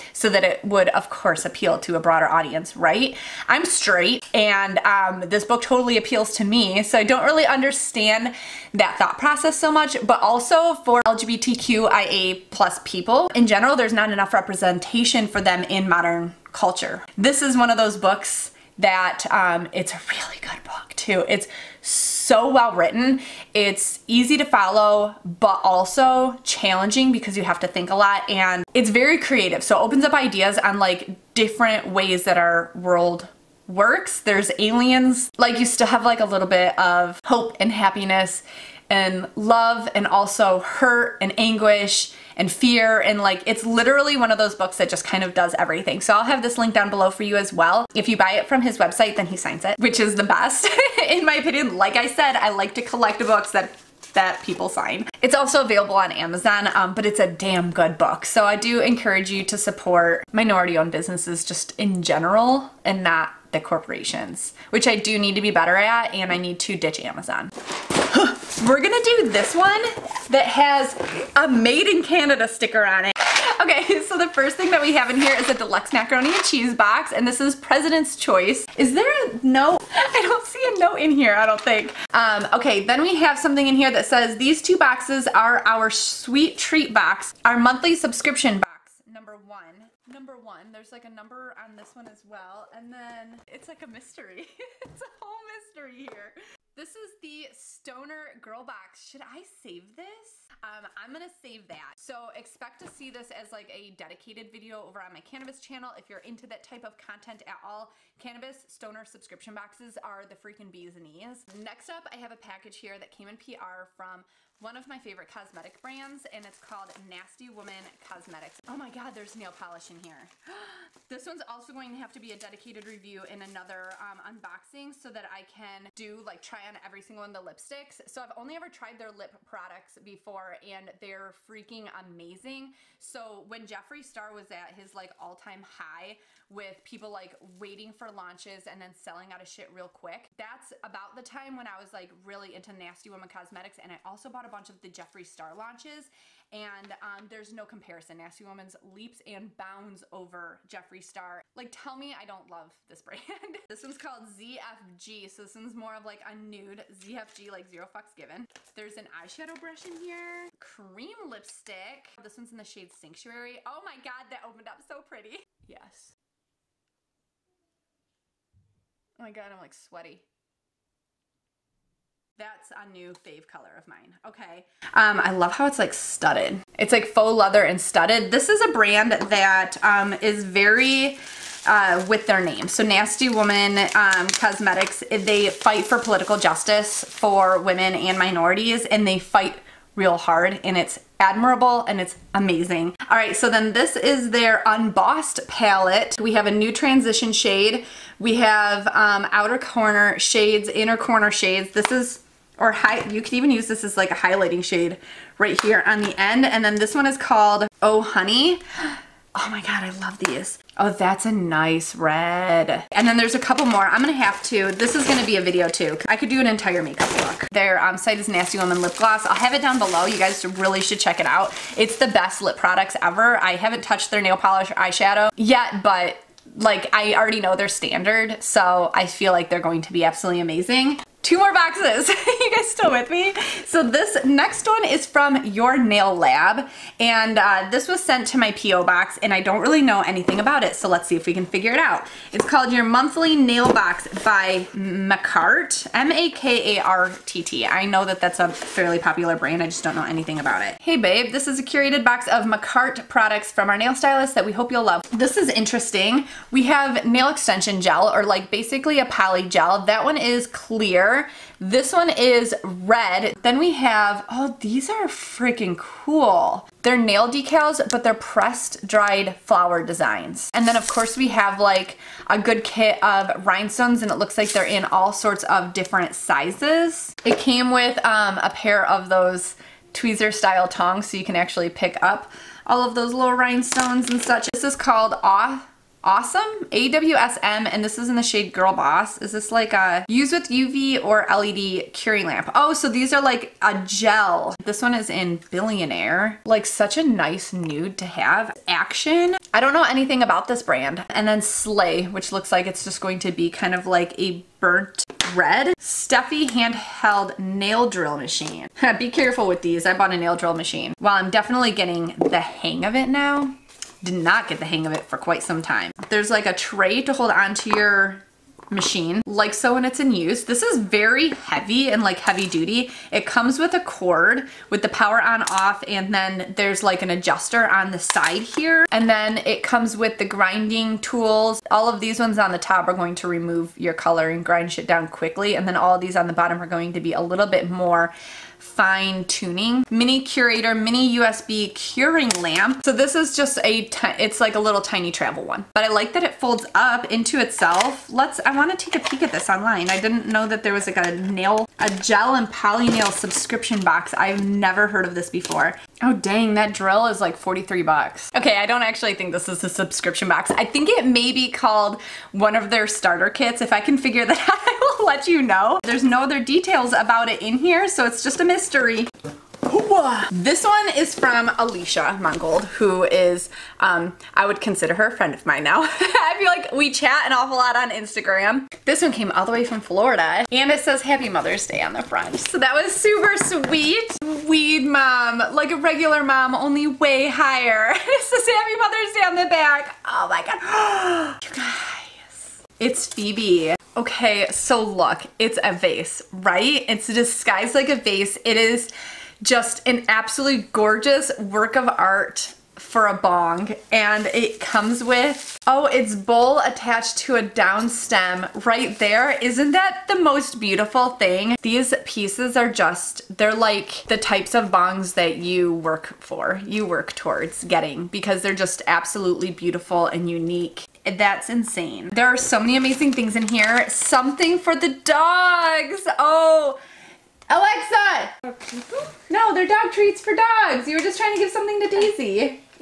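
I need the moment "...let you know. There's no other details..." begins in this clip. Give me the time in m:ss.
6:05.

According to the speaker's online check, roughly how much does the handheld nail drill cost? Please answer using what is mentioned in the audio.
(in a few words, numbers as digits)
43 dollars.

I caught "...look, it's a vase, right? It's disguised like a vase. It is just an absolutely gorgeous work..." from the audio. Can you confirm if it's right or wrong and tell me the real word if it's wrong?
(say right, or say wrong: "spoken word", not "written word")
right.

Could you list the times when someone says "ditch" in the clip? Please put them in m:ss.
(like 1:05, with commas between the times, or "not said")
1:06.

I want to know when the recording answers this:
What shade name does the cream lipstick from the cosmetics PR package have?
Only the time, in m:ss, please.
2:42.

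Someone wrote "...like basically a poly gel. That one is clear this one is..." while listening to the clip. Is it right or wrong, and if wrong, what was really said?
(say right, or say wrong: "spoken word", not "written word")
right.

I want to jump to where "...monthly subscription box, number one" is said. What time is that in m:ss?
1:27.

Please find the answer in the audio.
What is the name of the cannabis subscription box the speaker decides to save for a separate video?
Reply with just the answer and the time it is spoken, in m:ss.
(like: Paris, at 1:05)
Stoner Girl Box, at 1:37.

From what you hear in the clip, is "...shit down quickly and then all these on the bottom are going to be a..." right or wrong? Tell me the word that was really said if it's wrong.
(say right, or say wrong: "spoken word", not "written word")
right.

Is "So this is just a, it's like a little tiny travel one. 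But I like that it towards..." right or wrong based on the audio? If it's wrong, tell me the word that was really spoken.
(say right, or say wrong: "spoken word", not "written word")
wrong: "folds", not "towards".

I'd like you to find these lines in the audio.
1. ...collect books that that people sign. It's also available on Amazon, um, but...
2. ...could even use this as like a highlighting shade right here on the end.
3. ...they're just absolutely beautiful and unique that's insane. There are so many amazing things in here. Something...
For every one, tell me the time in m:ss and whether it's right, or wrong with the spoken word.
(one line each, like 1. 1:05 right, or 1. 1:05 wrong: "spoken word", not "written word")
1. 0:52 right
2. 3:23 right
3. 6:58 right.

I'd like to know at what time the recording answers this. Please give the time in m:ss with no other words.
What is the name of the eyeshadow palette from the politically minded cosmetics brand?
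3:14.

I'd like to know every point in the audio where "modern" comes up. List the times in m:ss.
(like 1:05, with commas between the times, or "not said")
0:15.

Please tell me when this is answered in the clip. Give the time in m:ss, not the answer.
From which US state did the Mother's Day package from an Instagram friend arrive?
6:19.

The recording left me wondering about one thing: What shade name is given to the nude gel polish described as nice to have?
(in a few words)
Billionaire.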